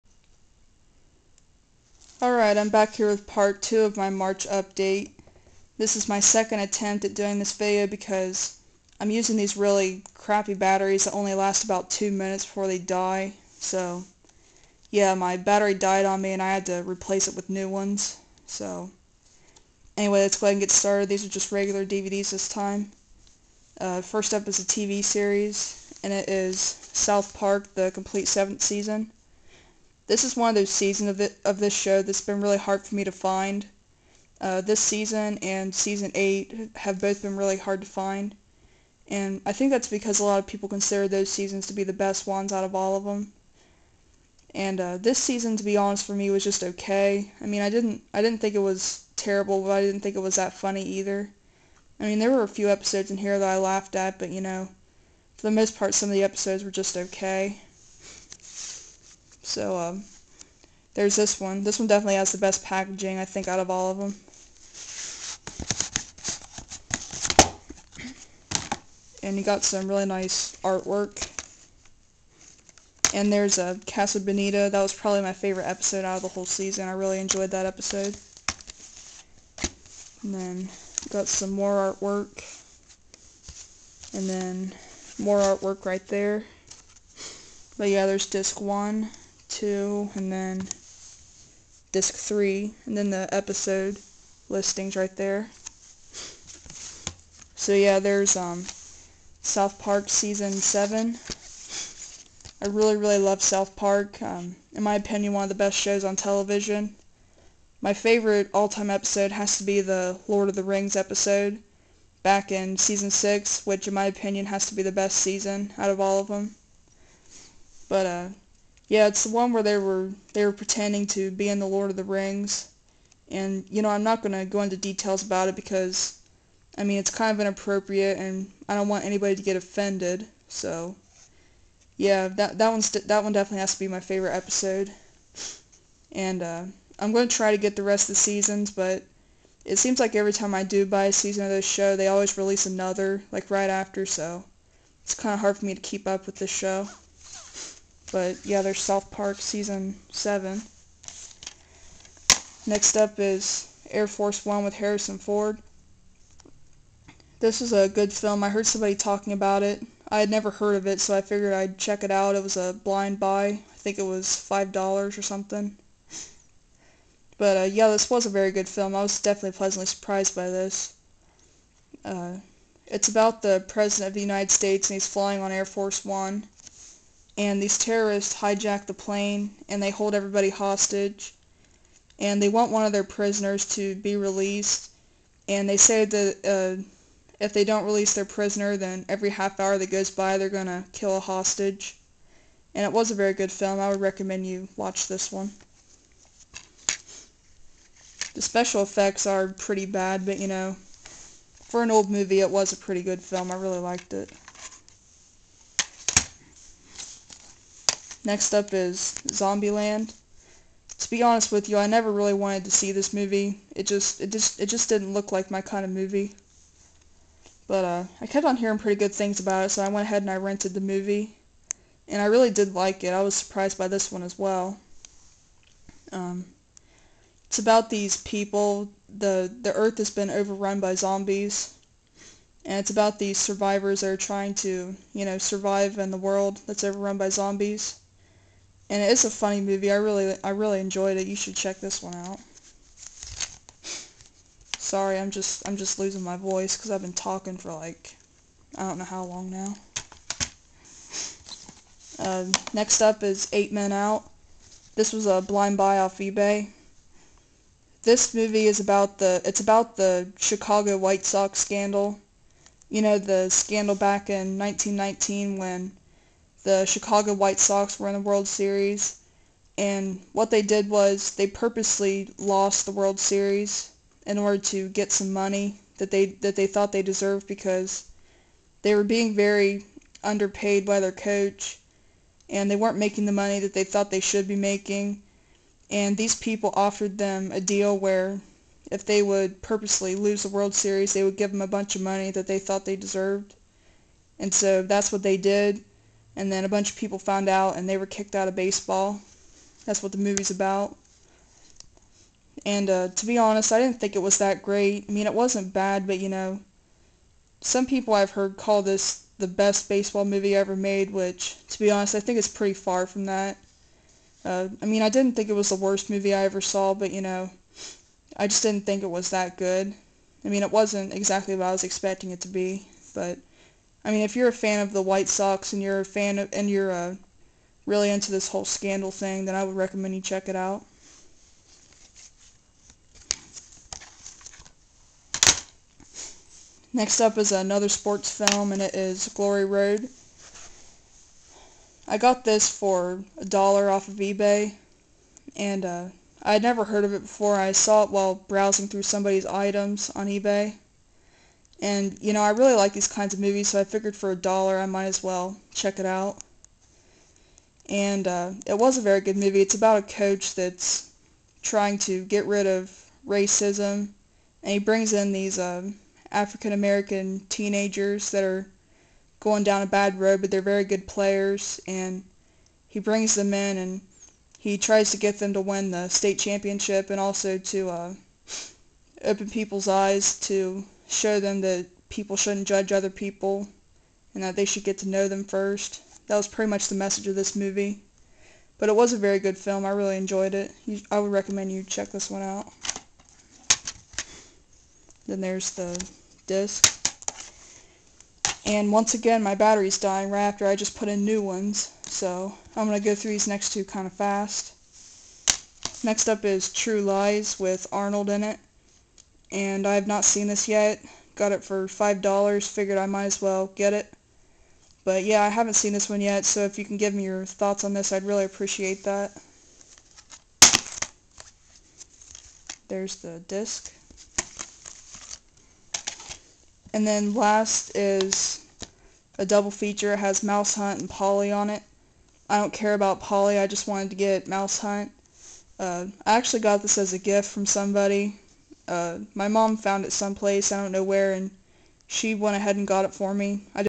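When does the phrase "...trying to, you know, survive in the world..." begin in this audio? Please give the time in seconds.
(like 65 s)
234 s.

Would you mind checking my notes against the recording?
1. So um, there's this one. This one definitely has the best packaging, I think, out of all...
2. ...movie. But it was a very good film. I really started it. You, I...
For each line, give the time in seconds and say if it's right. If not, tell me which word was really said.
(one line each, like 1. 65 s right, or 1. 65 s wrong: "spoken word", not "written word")
1. 59 s right
2. 387 s wrong: "enjoyed", not "started".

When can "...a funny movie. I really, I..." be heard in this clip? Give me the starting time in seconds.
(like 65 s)
239 s.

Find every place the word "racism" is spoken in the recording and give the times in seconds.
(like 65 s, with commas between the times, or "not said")
363 s.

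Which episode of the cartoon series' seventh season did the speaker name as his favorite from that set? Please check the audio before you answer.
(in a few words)
Casa Bonita.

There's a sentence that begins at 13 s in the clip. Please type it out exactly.
So, yeah, my battery died on me and I had to replace it with new ones.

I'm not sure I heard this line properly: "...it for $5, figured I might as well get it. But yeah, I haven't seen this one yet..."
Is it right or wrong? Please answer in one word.
right.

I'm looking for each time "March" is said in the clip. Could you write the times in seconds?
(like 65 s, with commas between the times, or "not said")
4 s.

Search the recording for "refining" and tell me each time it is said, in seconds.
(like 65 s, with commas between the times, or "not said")
not said.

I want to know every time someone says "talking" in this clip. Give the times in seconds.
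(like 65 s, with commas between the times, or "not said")
158 s, 247 s.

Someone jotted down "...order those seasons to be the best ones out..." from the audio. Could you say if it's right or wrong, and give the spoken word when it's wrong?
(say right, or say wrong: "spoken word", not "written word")
wrong: "consider", not "order".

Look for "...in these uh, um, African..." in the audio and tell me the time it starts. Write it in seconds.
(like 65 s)
365 s.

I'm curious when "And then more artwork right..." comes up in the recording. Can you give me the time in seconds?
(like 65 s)
84 s.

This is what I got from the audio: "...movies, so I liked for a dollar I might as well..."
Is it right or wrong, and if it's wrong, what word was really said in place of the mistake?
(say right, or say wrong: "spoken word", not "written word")
wrong: "figured", not "liked".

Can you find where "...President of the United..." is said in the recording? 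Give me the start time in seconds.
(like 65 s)
173 s.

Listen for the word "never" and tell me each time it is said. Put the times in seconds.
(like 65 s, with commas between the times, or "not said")
160 s, 211 s, 346 s.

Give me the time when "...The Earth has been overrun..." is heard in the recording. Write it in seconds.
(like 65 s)
229 s.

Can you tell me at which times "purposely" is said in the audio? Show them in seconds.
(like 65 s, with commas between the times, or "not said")
271 s, 289 s.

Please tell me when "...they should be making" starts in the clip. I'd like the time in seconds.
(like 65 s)
284 s.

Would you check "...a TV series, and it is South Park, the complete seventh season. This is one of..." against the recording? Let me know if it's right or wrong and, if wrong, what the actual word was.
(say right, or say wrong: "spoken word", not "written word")
right.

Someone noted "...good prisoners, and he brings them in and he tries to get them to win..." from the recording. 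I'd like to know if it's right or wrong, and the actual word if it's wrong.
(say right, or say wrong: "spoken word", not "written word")
wrong: "players", not "prisoners".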